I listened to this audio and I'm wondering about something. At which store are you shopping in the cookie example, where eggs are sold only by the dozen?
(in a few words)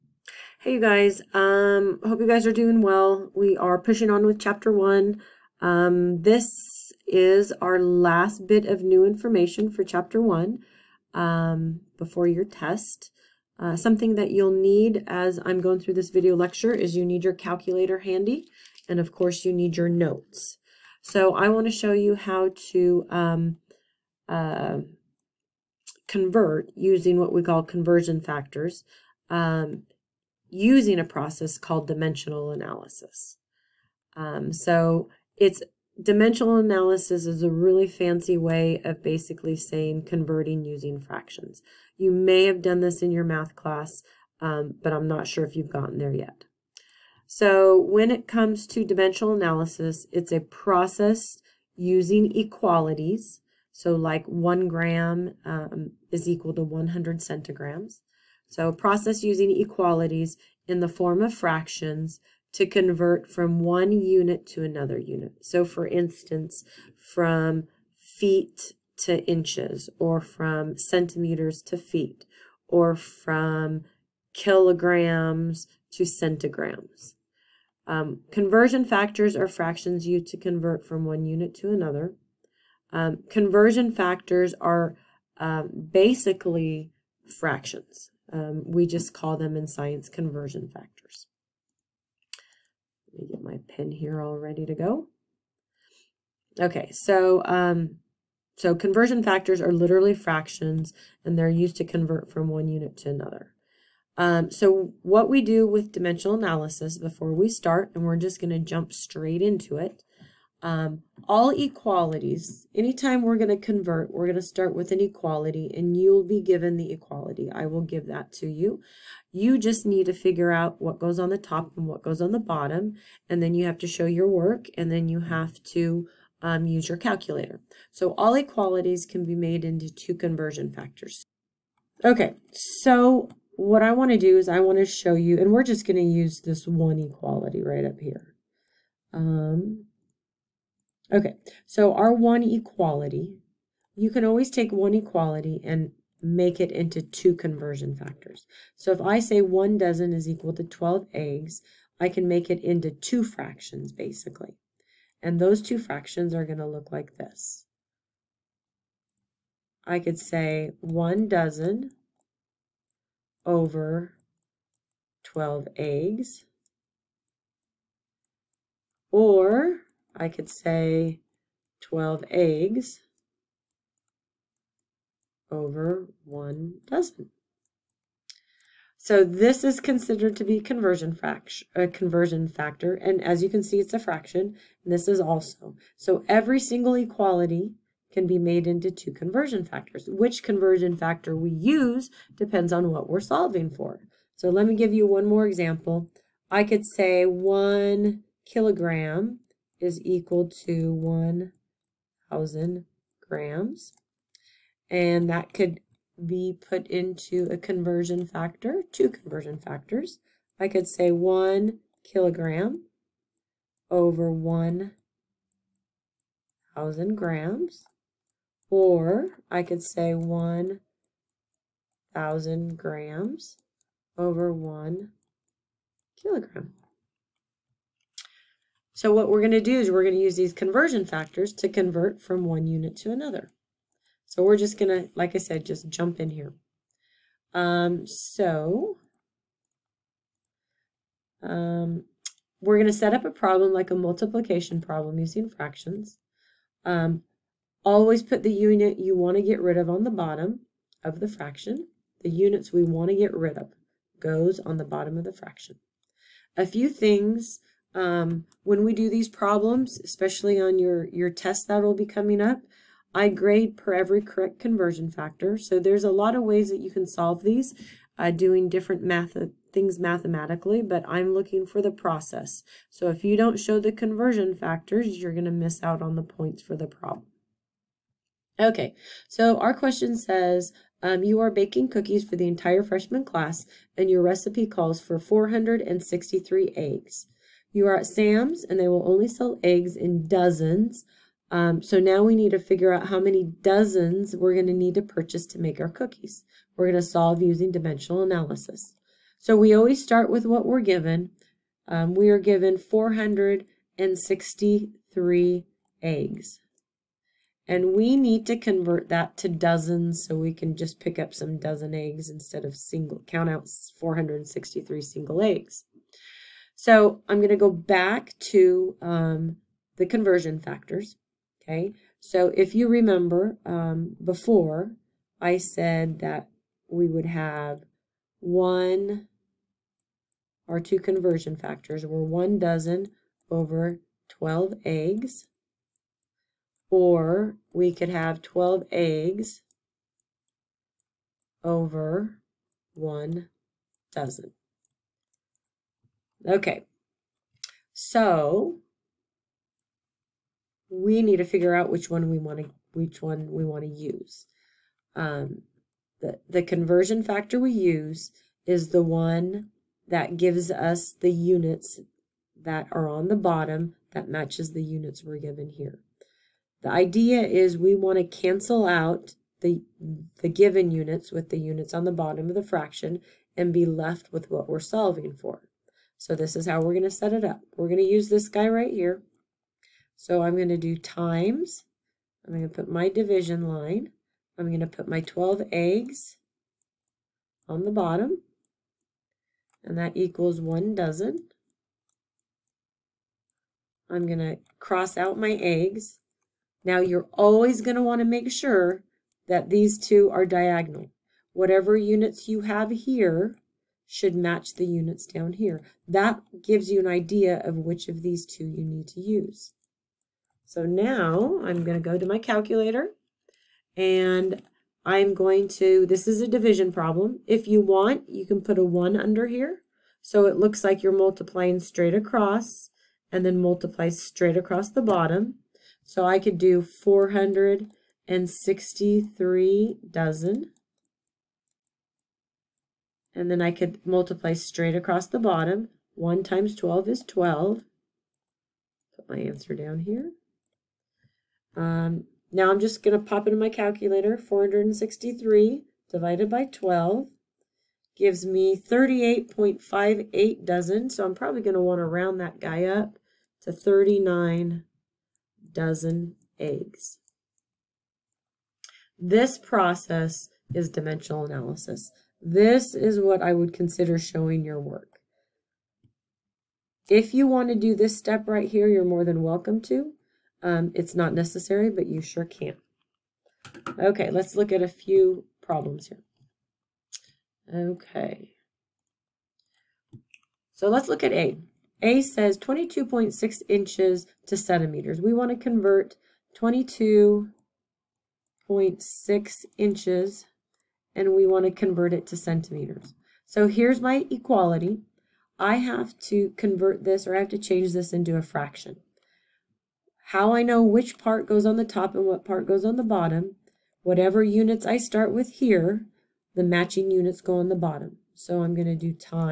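Sam's.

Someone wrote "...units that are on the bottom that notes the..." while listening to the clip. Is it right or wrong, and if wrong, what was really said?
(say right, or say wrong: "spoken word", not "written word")
wrong: "matches", not "notes".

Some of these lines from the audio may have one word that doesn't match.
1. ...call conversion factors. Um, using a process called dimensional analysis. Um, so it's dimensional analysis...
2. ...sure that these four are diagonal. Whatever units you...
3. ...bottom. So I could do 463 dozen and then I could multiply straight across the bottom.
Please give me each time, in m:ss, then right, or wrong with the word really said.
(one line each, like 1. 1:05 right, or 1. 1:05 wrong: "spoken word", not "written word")
1. 0:27 right
2. 6:38 wrong: "two", not "four"
3. 7:05 right.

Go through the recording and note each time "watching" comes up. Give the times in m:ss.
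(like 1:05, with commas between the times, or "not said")
not said.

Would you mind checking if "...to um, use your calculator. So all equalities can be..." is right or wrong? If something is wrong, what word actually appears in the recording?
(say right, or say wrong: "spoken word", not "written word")
right.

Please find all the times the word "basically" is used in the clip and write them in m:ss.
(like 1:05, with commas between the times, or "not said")
0:39, 1:25, 2:33.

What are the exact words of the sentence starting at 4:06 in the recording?
Um, always put the unit you want to get rid of on the bottom of the fraction.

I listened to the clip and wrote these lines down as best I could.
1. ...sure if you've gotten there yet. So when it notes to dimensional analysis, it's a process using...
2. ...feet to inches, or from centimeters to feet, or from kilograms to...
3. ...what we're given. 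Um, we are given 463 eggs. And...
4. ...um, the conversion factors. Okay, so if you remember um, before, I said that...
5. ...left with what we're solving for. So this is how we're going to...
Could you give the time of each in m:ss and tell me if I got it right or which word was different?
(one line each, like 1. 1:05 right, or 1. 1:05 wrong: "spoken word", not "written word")
1. 0:45 wrong: "comes", not "notes"
2. 1:07 right
3. 5:00 right
4. 5:19 right
5. 6:13 right.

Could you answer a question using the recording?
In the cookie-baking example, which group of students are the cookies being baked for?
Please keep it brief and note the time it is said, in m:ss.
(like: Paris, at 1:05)
the entire freshman class, at 4:42.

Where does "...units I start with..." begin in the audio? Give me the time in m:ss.
8:24.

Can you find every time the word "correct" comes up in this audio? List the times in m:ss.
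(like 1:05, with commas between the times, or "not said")
4:24.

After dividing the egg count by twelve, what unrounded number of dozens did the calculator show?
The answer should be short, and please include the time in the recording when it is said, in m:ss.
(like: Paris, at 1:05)
38.58, at 7:28.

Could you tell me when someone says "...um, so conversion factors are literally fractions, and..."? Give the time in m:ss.
1:37.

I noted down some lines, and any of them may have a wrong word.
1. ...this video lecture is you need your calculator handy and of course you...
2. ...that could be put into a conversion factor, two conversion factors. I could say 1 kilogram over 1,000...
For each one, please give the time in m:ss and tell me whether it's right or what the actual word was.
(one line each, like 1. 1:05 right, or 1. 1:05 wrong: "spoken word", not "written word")
1. 0:15 right
2. 3:25 right.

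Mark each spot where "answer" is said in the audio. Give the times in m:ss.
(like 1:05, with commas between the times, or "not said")
7:19.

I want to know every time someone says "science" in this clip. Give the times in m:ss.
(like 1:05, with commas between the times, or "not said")
1:29.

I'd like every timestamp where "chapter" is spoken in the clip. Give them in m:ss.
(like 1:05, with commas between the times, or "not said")
0:04, 0:09.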